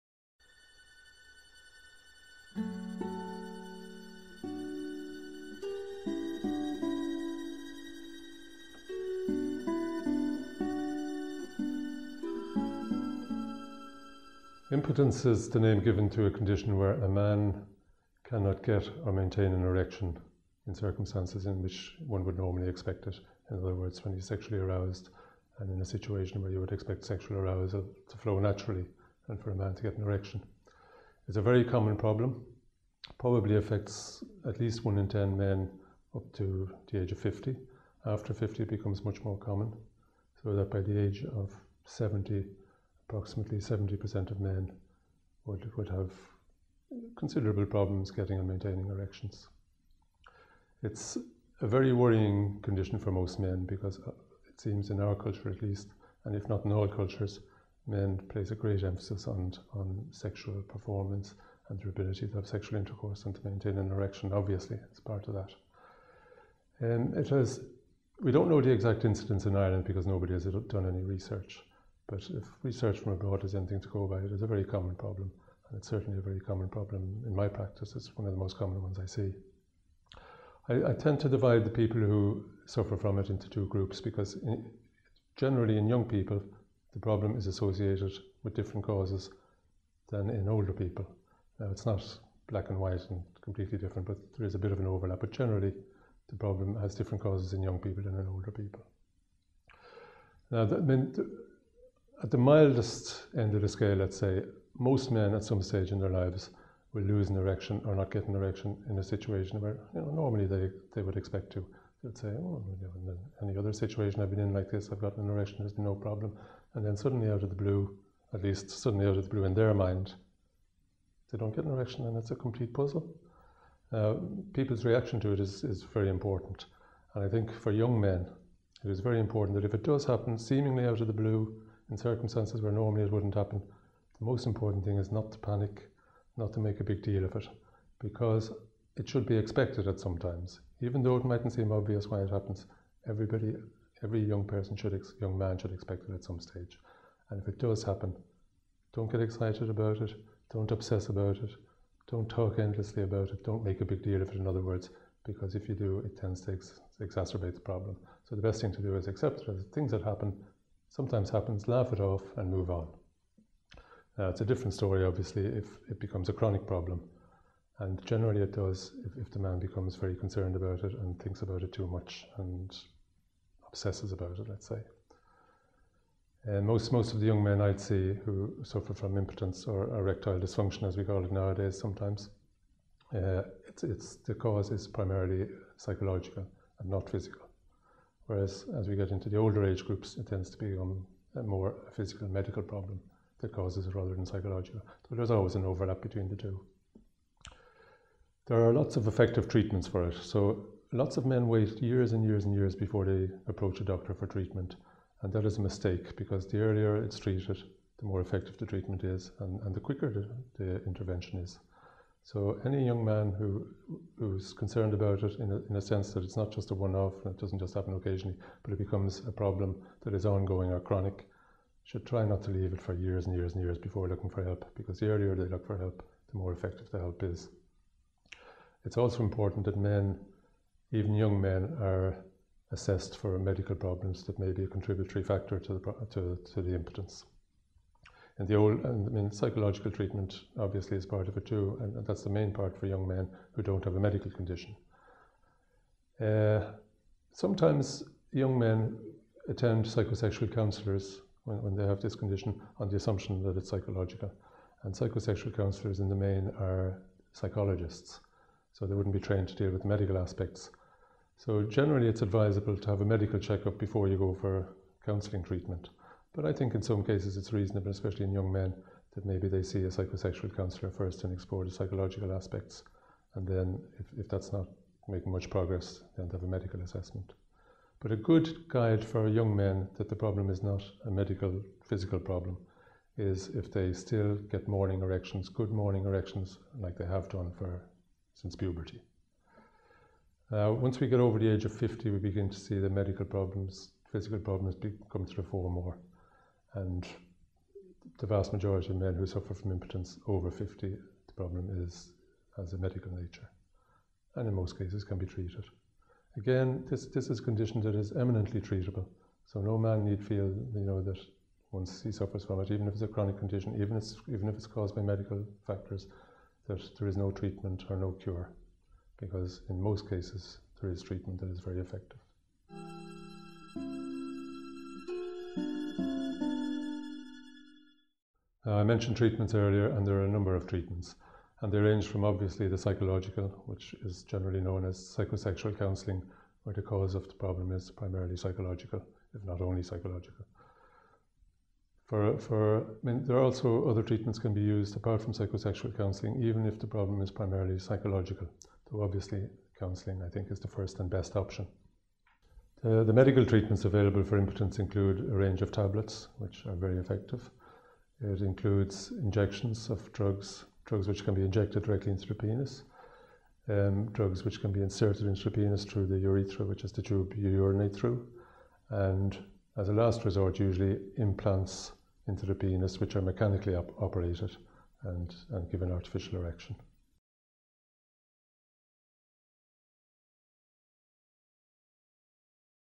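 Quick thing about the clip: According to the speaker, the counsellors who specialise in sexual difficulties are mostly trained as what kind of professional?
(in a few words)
psychologists.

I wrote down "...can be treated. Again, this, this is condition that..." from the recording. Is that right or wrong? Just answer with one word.
right.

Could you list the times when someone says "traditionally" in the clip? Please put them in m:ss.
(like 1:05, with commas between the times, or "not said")
not said.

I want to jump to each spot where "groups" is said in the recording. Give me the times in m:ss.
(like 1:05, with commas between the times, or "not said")
1:23, 3:09.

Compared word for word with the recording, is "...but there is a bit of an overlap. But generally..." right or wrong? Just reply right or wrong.
right.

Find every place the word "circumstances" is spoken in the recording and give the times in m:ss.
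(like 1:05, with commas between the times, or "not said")
0:20, 2:11.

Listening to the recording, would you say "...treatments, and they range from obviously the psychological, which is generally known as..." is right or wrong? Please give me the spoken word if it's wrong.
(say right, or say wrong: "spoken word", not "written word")
right.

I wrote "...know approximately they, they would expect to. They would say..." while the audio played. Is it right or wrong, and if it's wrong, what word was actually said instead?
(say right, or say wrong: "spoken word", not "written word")
wrong: "normally", not "approximately".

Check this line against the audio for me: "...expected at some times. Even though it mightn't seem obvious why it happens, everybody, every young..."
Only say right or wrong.
right.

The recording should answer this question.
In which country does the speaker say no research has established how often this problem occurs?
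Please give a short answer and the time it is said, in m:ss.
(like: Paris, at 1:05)
Ireland, at 1:09.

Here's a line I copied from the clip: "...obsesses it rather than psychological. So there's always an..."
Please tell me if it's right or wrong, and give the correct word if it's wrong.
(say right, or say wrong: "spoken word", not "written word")
wrong: "causes", not "obsesses".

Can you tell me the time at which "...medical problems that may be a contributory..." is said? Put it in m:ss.
3:53.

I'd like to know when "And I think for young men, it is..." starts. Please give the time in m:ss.
2:07.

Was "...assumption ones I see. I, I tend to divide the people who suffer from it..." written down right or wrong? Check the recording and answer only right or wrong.
wrong.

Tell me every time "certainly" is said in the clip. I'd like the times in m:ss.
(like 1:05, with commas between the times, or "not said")
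1:15.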